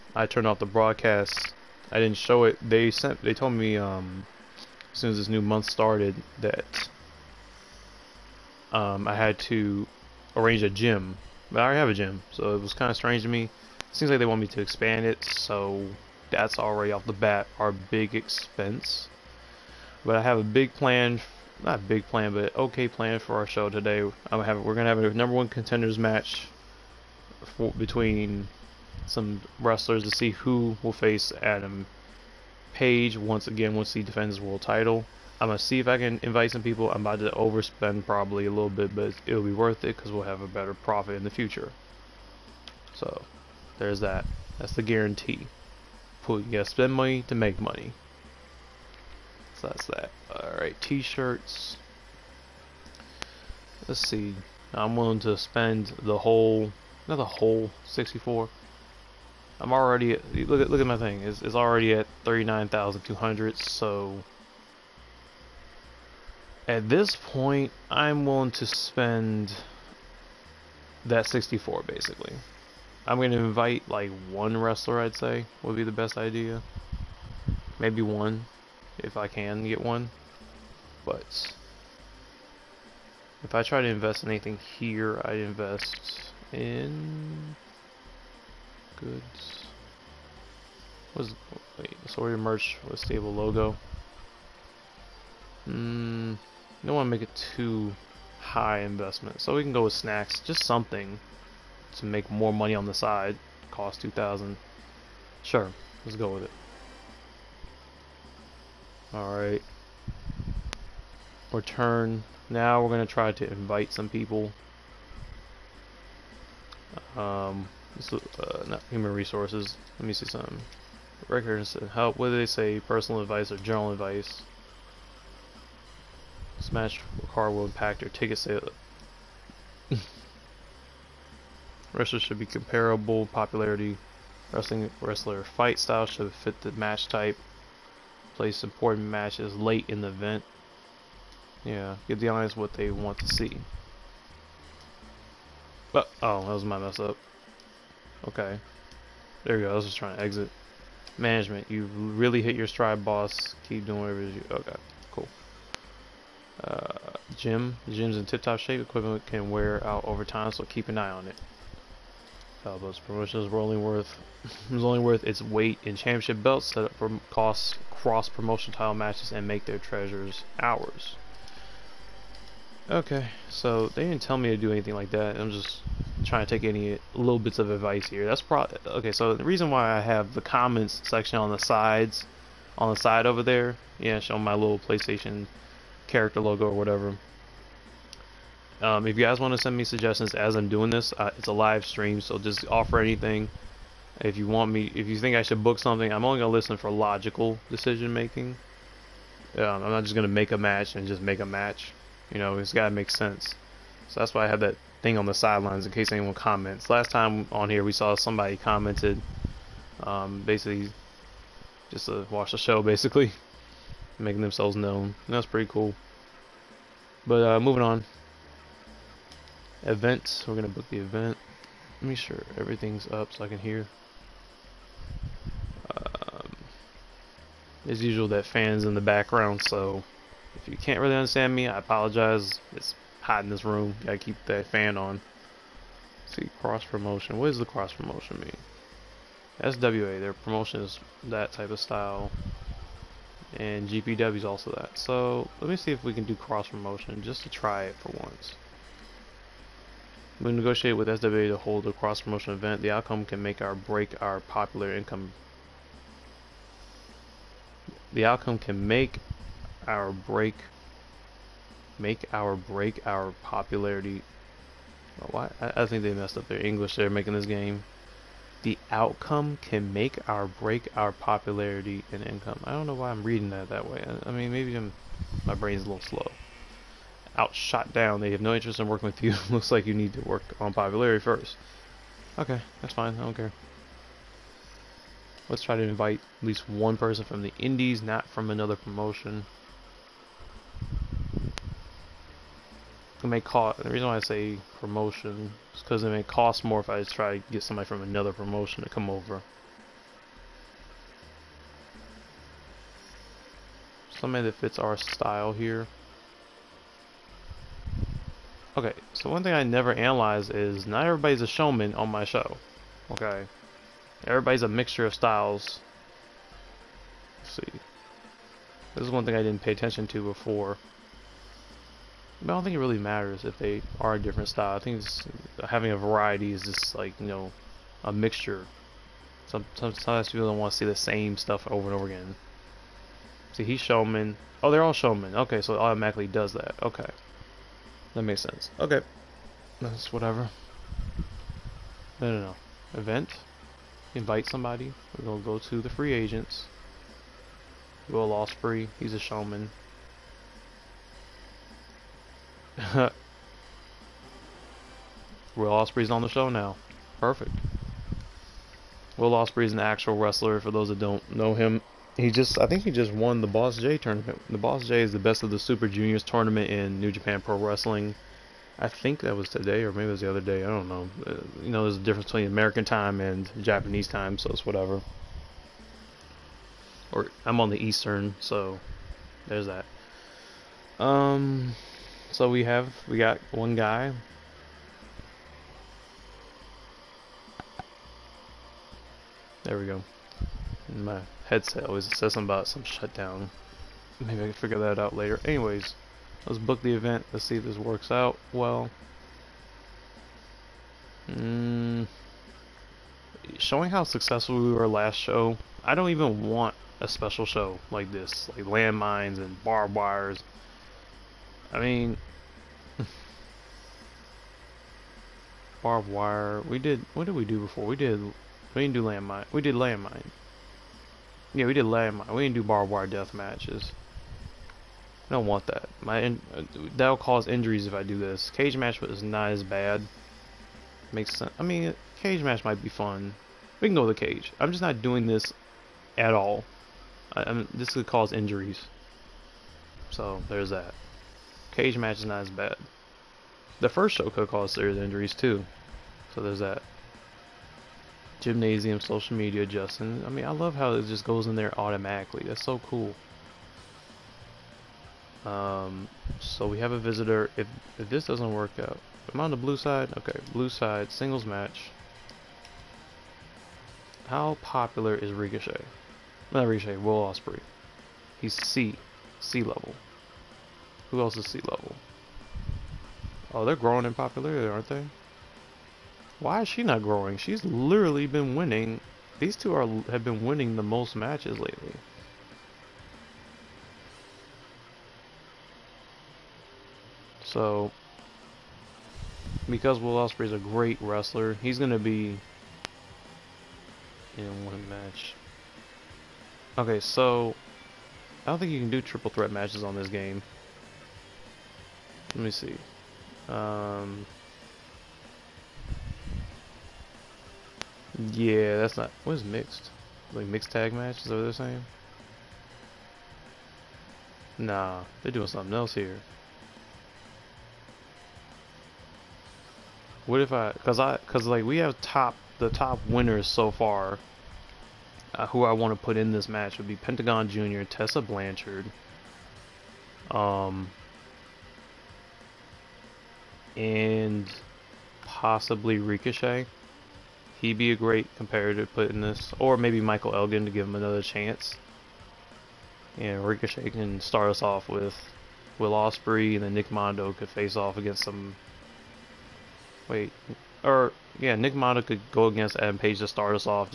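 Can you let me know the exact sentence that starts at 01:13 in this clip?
I'm gonna invite like one wrestler.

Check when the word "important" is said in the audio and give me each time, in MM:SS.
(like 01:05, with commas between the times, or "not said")
02:18.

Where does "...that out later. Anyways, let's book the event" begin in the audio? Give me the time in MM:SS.
06:34.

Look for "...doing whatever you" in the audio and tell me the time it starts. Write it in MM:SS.
02:33.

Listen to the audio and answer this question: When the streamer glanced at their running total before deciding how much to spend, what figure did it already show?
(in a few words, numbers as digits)
39,200.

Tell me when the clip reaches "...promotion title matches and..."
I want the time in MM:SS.
02:48.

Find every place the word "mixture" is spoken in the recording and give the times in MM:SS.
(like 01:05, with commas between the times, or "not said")
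05:14, 05:28.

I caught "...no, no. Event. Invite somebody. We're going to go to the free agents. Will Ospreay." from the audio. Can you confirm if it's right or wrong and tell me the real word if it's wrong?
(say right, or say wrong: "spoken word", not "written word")
right.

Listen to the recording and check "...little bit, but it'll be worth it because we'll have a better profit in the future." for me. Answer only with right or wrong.
right.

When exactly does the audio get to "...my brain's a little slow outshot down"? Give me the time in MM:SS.
04:35.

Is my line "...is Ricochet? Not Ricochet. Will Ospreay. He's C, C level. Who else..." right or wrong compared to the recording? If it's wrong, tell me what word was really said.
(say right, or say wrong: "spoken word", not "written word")
right.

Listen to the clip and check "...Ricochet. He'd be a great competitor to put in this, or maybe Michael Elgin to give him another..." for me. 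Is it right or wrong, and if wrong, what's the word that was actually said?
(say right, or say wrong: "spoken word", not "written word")
right.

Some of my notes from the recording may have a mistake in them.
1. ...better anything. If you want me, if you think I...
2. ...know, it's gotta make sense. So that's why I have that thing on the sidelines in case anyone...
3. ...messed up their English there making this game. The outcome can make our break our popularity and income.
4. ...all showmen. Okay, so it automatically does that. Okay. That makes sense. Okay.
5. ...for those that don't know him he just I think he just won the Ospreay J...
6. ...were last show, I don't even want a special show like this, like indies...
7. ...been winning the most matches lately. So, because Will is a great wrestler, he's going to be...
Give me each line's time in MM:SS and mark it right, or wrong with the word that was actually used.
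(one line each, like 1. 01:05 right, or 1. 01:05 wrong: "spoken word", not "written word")
1. 03:12 wrong: "offer", not "better"
2. 03:22 right
3. 04:26 right
4. 05:34 right
5. 06:00 wrong: "Boss", not "Ospreay"
6. 06:44 wrong: "landmines", not "indies"
7. 08:00 right.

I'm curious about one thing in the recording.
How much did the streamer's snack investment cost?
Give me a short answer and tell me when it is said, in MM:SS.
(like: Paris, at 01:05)
2000, at 01:44.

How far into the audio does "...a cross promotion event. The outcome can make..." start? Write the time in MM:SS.
04:11.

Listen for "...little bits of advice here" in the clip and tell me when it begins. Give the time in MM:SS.
02:57.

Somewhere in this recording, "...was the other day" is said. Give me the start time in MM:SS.
06:10.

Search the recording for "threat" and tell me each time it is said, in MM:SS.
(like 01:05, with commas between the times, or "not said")
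08:19.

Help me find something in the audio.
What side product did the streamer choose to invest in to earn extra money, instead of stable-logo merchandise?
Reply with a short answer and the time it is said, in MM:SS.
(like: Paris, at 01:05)
Snacks, at 01:39.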